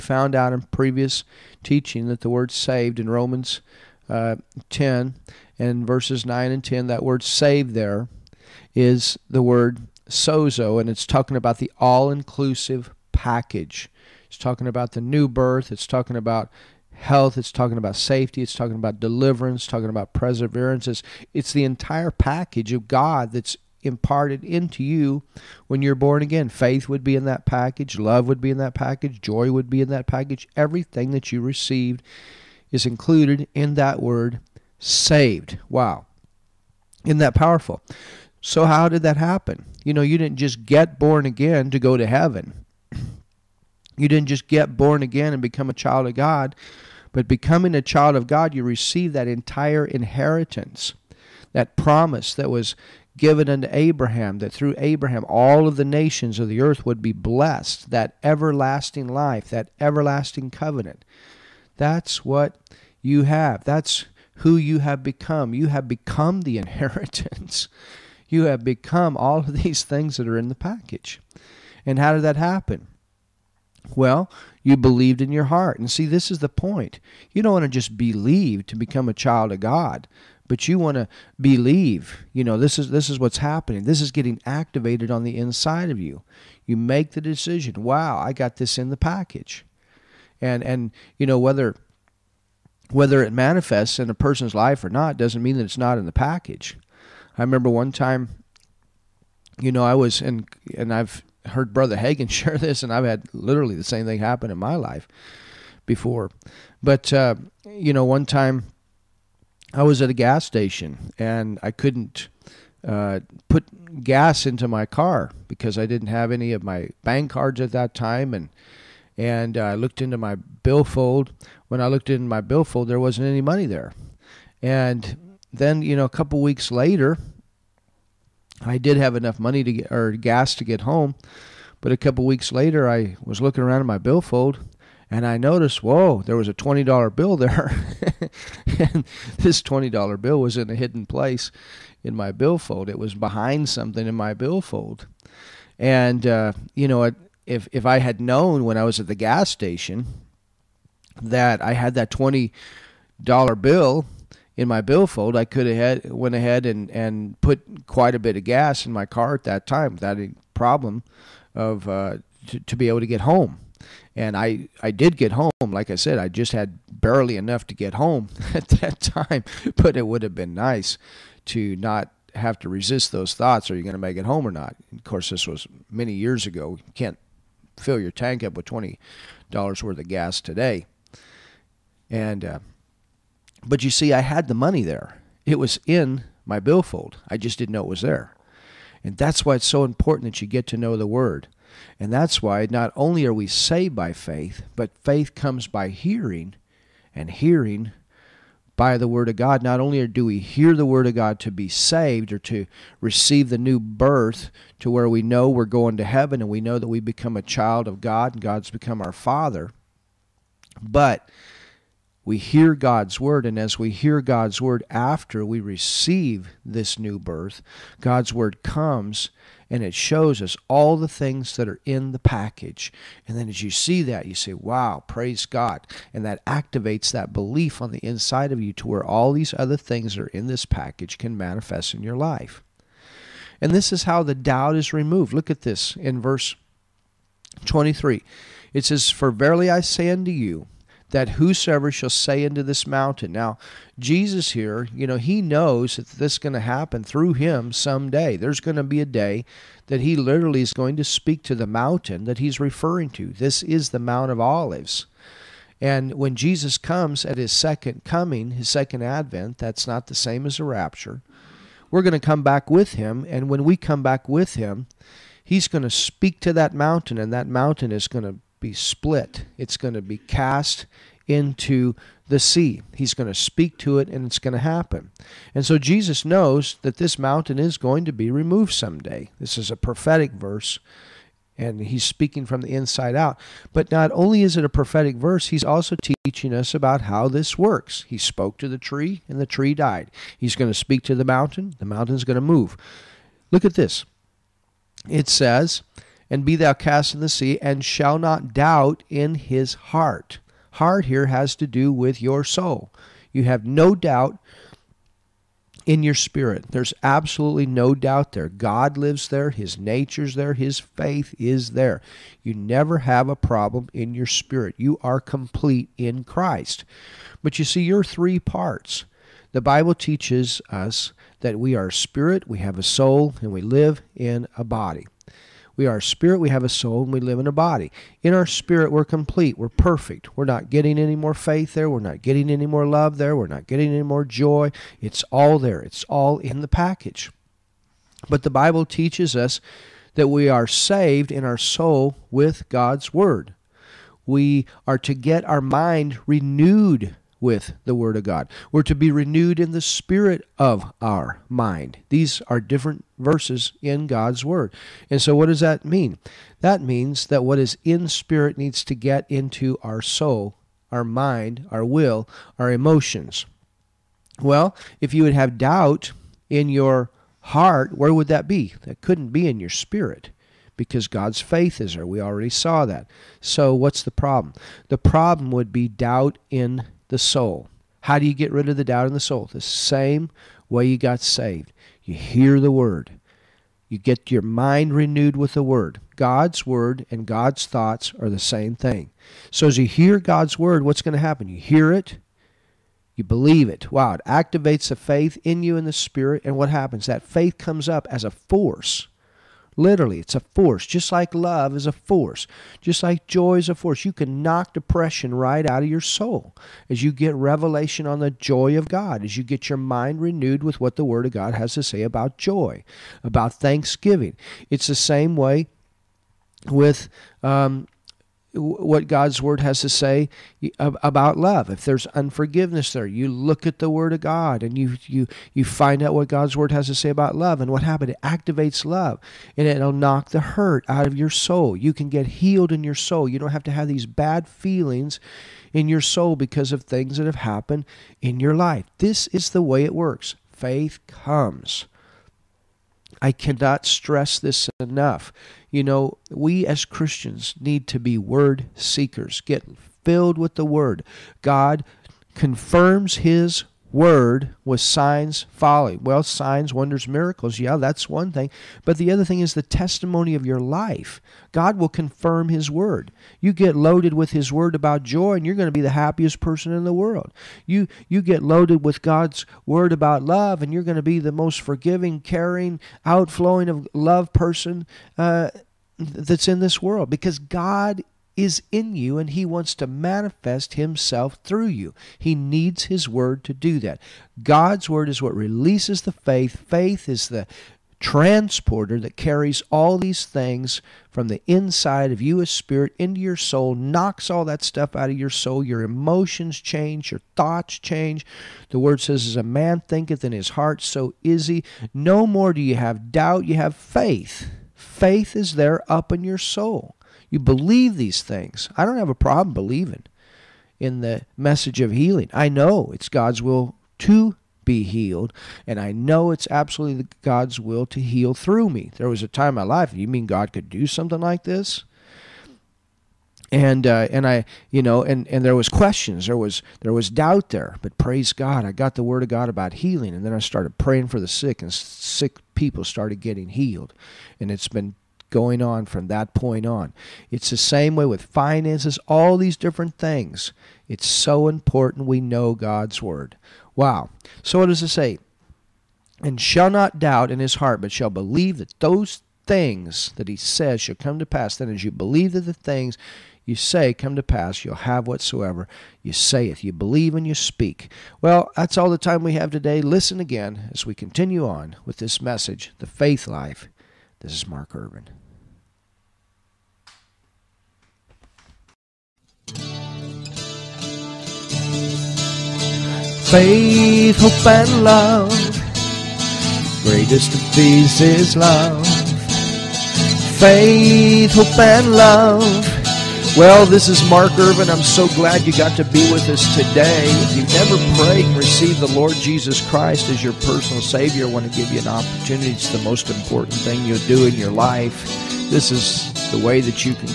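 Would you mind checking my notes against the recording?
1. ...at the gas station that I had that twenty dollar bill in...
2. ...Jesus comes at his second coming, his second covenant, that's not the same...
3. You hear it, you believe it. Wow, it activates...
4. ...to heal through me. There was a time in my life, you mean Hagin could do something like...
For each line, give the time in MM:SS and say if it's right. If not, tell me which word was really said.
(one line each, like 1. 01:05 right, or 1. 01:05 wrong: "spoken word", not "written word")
1. 02:28 right
2. 04:16 wrong: "advent", not "covenant"
3. 06:31 right
4. 08:37 wrong: "God", not "Hagin".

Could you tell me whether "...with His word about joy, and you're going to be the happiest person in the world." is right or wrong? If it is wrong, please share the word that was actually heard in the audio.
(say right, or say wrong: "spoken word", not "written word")
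right.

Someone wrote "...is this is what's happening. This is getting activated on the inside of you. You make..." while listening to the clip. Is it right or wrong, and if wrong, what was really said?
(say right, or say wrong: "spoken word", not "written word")
right.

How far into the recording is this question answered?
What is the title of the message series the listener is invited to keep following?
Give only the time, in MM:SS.
09:22.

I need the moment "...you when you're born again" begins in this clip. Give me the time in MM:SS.
00:24.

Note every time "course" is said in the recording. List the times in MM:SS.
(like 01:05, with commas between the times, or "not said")
02:55.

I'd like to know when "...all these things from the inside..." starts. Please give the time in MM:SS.
08:09.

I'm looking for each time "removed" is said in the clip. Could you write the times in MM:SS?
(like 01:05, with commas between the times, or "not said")
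03:54, 04:38.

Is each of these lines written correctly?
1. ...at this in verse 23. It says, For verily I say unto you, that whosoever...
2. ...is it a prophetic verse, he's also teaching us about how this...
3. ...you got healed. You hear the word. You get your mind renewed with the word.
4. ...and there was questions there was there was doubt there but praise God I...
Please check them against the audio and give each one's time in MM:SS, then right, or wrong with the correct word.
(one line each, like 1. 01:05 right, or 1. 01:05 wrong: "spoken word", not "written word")
1. 03:55 right
2. 04:44 right
3. 06:20 wrong: "saved", not "healed"
4. 08:45 right.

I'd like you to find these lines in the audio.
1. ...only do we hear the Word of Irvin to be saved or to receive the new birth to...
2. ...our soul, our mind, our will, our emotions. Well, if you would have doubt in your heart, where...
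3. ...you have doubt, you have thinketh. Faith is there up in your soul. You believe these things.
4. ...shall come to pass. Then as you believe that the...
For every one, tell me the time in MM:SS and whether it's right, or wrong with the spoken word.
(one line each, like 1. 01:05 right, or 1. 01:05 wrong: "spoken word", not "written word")
1. 03:19 wrong: "God", not "Irvin"
2. 05:59 right
3. 08:22 wrong: "faith", not "thinketh"
4. 09:10 right.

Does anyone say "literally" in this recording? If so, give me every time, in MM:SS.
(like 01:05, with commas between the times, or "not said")
01:43, 04:10, 06:39.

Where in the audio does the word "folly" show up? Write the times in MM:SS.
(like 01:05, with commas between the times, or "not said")
07:35.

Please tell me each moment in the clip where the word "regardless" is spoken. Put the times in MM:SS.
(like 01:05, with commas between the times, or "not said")
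not said.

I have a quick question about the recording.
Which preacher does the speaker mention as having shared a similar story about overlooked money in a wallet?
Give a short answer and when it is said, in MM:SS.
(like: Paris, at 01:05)
Brother Hagin, at 01:41.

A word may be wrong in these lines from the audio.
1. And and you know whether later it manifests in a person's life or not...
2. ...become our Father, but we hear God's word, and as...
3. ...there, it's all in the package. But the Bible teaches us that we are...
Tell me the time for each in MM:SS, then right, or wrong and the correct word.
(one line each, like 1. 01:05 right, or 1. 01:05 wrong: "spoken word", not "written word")
1. 01:30 wrong: "whether", not "later"
2. 03:28 right
3. 05:35 right.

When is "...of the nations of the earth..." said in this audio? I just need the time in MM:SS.
00:55.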